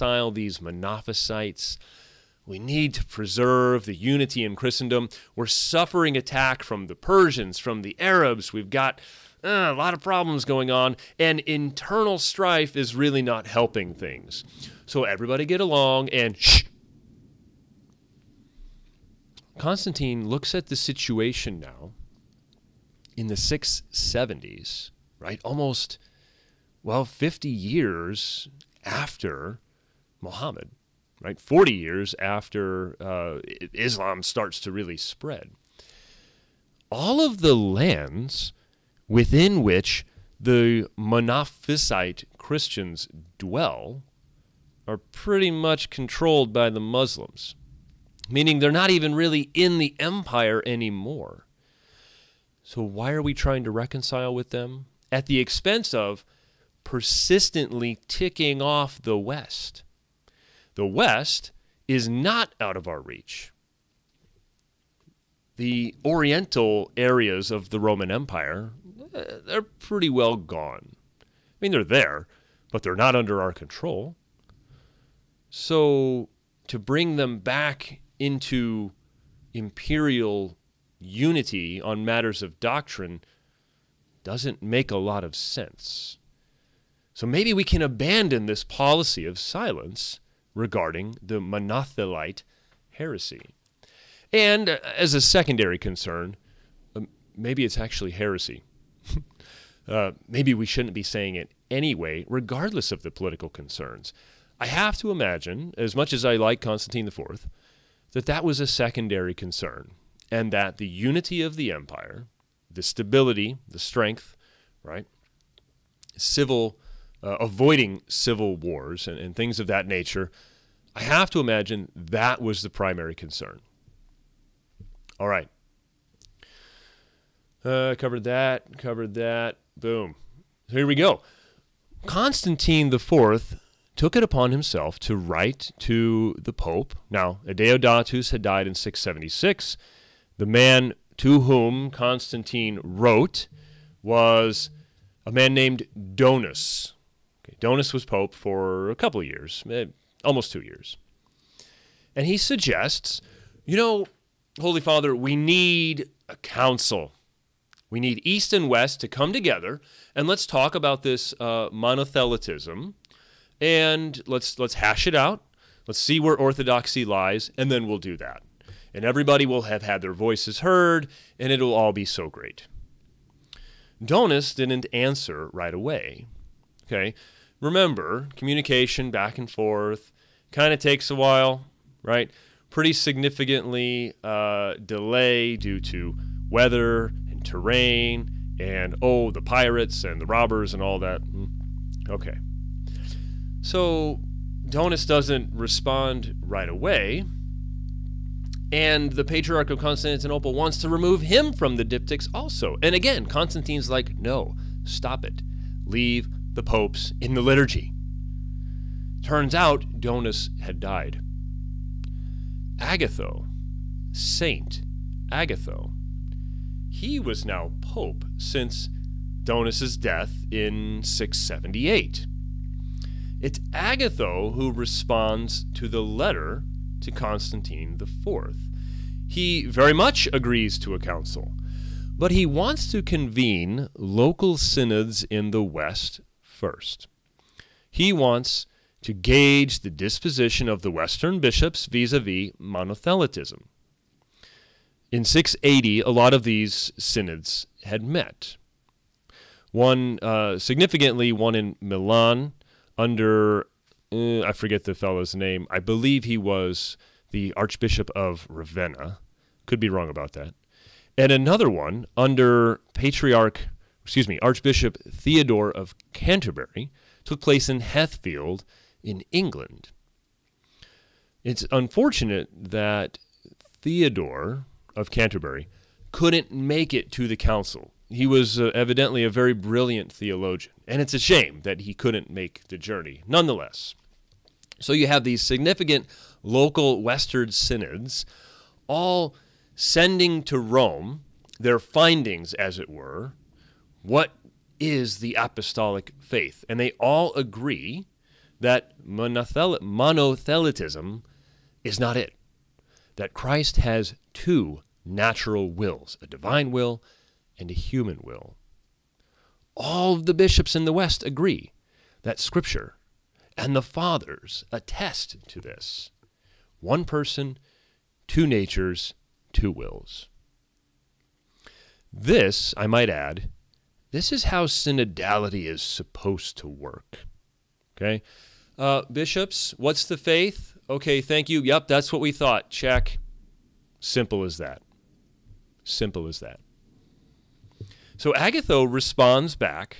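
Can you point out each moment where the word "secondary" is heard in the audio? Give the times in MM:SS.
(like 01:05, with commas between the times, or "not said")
01:35, 01:48.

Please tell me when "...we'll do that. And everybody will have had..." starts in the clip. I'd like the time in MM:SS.
02:47.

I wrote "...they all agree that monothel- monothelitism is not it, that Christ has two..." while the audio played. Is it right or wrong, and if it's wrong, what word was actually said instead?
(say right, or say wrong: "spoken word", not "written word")
right.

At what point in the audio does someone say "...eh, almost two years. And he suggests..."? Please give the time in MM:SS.
02:29.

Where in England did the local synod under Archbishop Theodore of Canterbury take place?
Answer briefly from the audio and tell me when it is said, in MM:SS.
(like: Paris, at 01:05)
Hethfield, at 04:27.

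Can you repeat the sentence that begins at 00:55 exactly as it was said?
At the expense of persistently ticking off the West.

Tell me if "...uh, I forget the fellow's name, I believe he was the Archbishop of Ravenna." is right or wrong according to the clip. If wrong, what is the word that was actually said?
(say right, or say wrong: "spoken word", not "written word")
right.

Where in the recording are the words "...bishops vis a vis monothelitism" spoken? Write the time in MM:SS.
04:01.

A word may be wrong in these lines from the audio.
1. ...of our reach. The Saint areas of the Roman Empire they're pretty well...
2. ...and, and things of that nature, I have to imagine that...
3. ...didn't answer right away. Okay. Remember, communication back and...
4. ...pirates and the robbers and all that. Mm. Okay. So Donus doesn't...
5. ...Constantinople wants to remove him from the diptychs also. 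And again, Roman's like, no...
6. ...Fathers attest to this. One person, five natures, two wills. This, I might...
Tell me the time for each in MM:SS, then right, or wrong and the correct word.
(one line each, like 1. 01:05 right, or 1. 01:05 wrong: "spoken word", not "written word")
1. 01:02 wrong: "Oriental", not "Saint"
2. 01:59 right
3. 02:54 right
4. 03:09 right
5. 03:19 wrong: "Constantine", not "Roman"
6. 05:13 wrong: "two", not "five".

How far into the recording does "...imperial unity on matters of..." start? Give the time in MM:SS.
01:19.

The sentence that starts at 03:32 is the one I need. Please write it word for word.
Agatho, Saint Agatho, he was now pope since Donus's death in 678.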